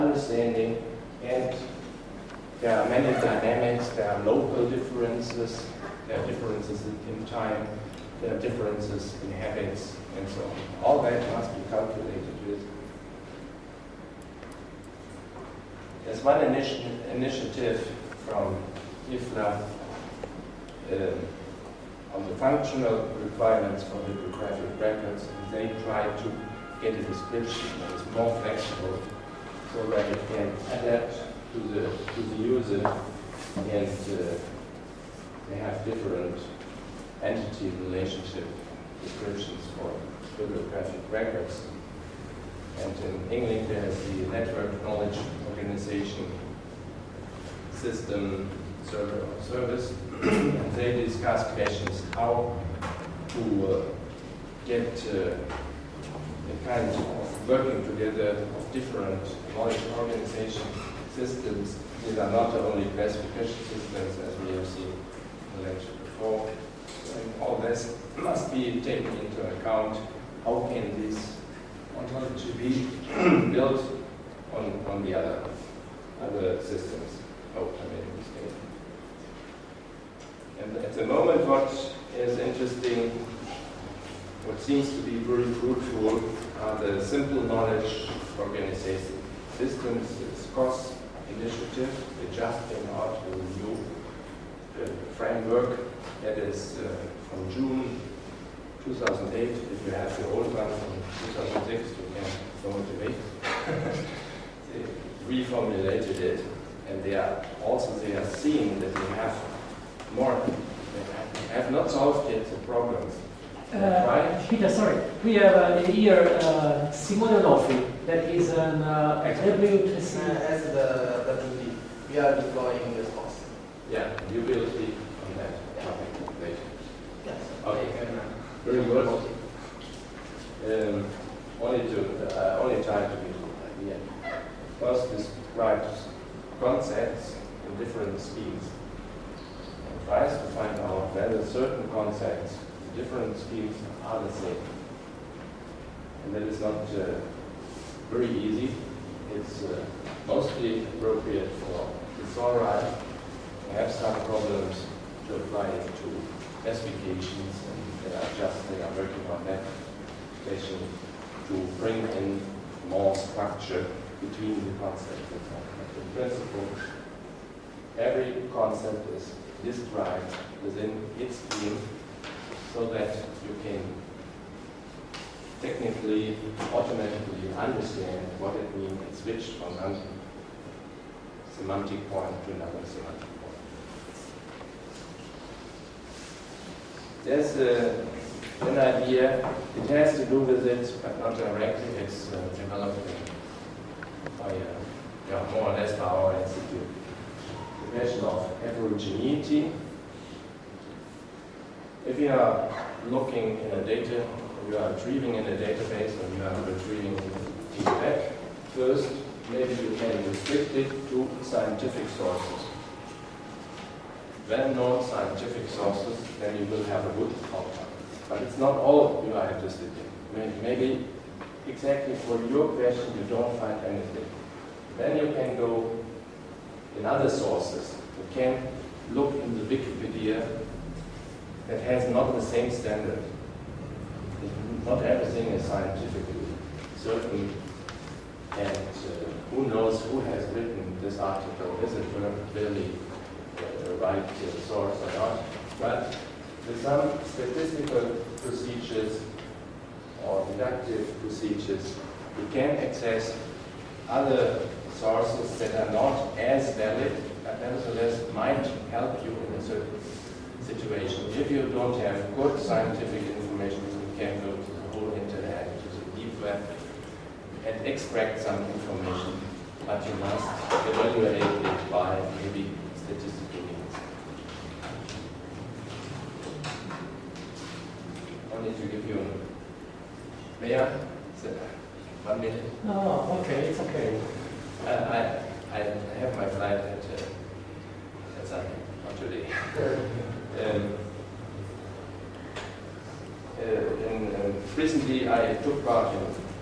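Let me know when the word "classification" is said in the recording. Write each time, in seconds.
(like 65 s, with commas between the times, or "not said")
62 s.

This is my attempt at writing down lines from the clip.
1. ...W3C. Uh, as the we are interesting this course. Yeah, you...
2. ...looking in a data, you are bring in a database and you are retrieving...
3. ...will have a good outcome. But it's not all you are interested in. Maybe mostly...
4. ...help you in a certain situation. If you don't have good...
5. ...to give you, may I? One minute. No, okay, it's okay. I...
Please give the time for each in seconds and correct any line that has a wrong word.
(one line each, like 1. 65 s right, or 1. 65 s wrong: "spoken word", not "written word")
1. 119 s wrong: "deploying", not "interesting"
2. 203 s wrong: "retrieving", not "bring"
3. 216 s wrong: "exactly", not "mostly"
4. 258 s right
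5. 278 s right.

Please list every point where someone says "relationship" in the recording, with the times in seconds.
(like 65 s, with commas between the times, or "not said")
37 s.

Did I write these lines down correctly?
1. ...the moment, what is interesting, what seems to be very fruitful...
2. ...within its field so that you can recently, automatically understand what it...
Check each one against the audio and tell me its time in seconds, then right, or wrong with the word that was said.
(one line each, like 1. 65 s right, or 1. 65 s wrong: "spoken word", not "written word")
1. 80 s right
2. 170 s wrong: "technically", not "recently".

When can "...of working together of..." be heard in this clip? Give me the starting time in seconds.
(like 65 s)
56 s.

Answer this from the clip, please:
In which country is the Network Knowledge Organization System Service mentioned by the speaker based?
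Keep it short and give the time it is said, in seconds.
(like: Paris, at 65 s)
England, at 43 s.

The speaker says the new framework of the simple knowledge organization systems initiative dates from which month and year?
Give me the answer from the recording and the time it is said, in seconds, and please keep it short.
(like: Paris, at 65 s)
June 2008, at 97 s.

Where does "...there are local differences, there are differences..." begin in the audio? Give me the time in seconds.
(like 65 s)
3 s.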